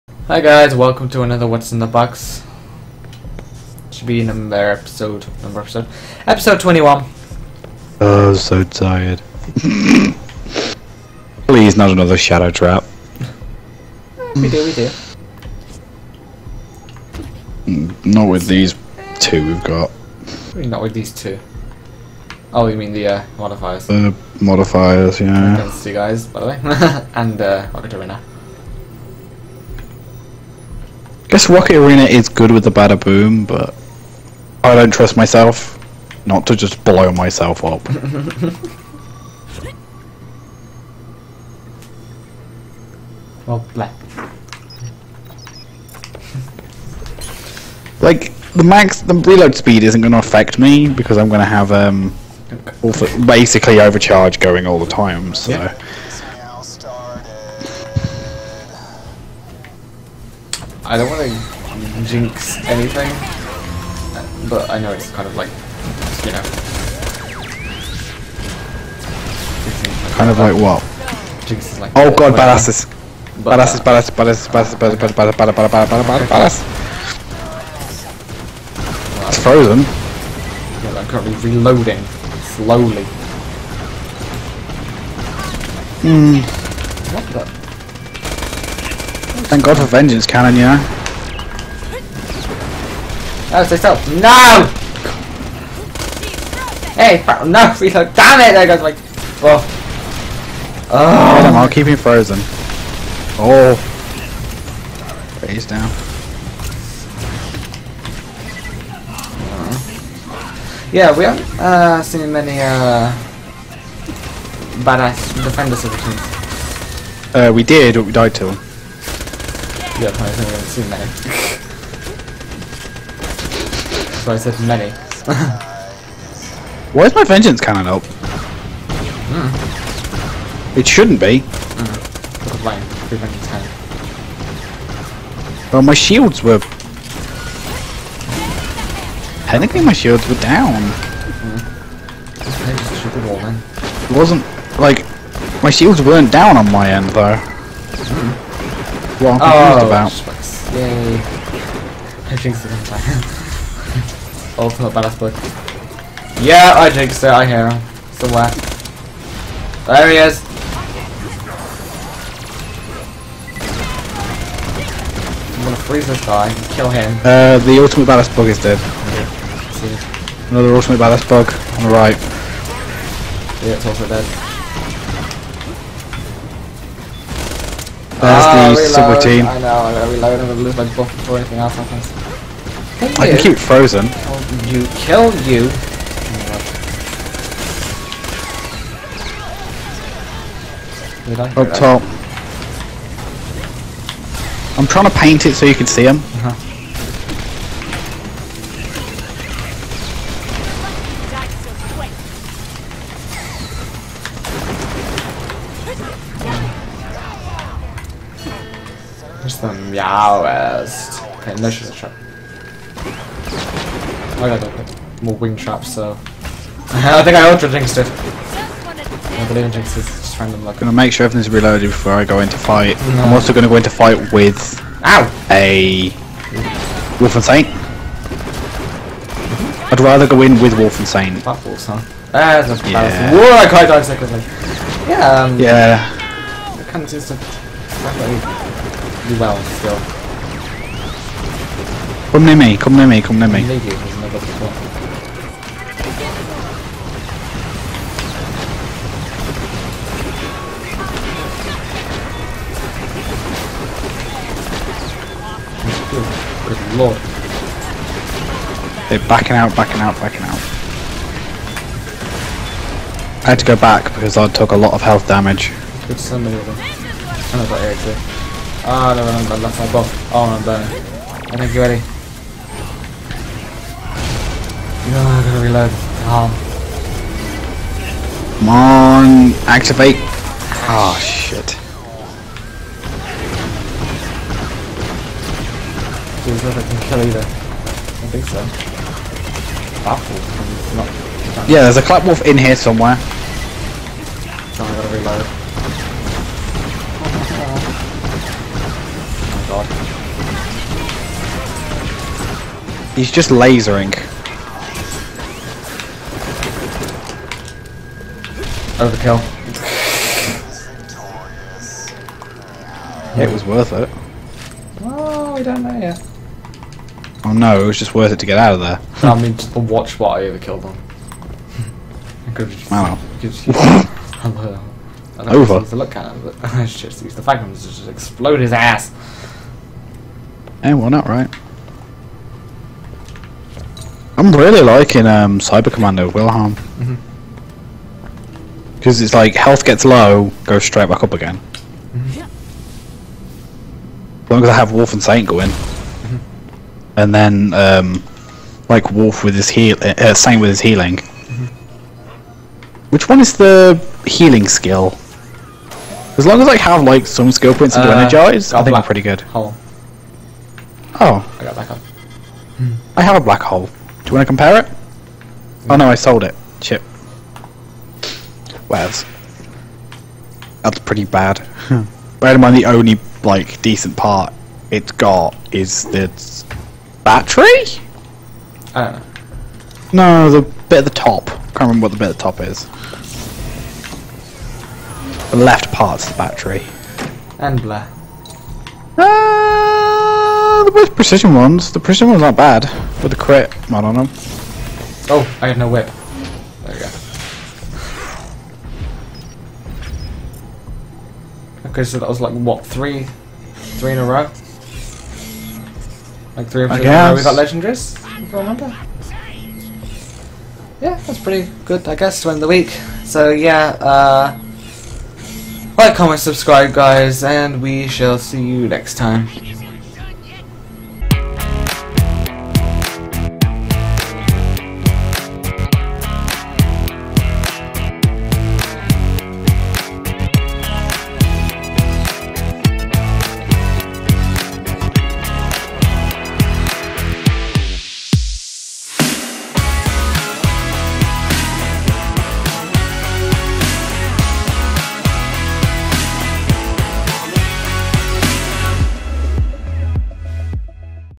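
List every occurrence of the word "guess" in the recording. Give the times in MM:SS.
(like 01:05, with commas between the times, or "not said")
00:31, 06:52.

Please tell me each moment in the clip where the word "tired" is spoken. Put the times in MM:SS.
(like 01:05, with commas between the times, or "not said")
00:08.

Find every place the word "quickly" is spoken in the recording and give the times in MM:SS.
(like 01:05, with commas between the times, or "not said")
03:54.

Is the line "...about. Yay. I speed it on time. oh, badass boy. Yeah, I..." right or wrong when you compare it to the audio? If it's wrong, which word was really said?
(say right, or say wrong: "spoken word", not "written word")
wrong: "jinxed", not "speed".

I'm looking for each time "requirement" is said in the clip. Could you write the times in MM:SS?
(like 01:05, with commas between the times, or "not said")
not said.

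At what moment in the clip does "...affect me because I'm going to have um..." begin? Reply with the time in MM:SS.
00:50.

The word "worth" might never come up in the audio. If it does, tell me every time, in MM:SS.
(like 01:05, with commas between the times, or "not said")
05:13, 05:18.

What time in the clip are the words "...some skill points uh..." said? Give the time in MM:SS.
05:57.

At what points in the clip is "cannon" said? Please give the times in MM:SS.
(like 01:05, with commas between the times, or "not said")
01:30, 02:07.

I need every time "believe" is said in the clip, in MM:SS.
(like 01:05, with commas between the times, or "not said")
03:39.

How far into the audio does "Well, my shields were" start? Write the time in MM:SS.
02:15.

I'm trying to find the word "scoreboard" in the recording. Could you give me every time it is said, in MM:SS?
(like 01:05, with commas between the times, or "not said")
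not said.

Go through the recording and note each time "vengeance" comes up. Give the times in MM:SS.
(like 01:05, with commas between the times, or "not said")
01:29, 02:07.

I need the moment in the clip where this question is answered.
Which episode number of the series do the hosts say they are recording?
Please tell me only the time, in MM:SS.
00:06.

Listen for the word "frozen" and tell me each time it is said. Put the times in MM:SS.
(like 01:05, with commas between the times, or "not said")
01:19, 01:41, 03:03.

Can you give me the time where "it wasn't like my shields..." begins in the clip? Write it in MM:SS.
02:24.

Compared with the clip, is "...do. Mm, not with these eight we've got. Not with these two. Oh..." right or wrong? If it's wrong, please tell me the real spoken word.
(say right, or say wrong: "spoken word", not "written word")
wrong: "two", not "eight".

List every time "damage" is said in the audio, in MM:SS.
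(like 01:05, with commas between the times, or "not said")
04:25.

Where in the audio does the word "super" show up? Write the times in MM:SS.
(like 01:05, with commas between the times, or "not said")
02:59.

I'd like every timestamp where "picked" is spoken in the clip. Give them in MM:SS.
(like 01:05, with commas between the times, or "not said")
not said.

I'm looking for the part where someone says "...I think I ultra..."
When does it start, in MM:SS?
03:36.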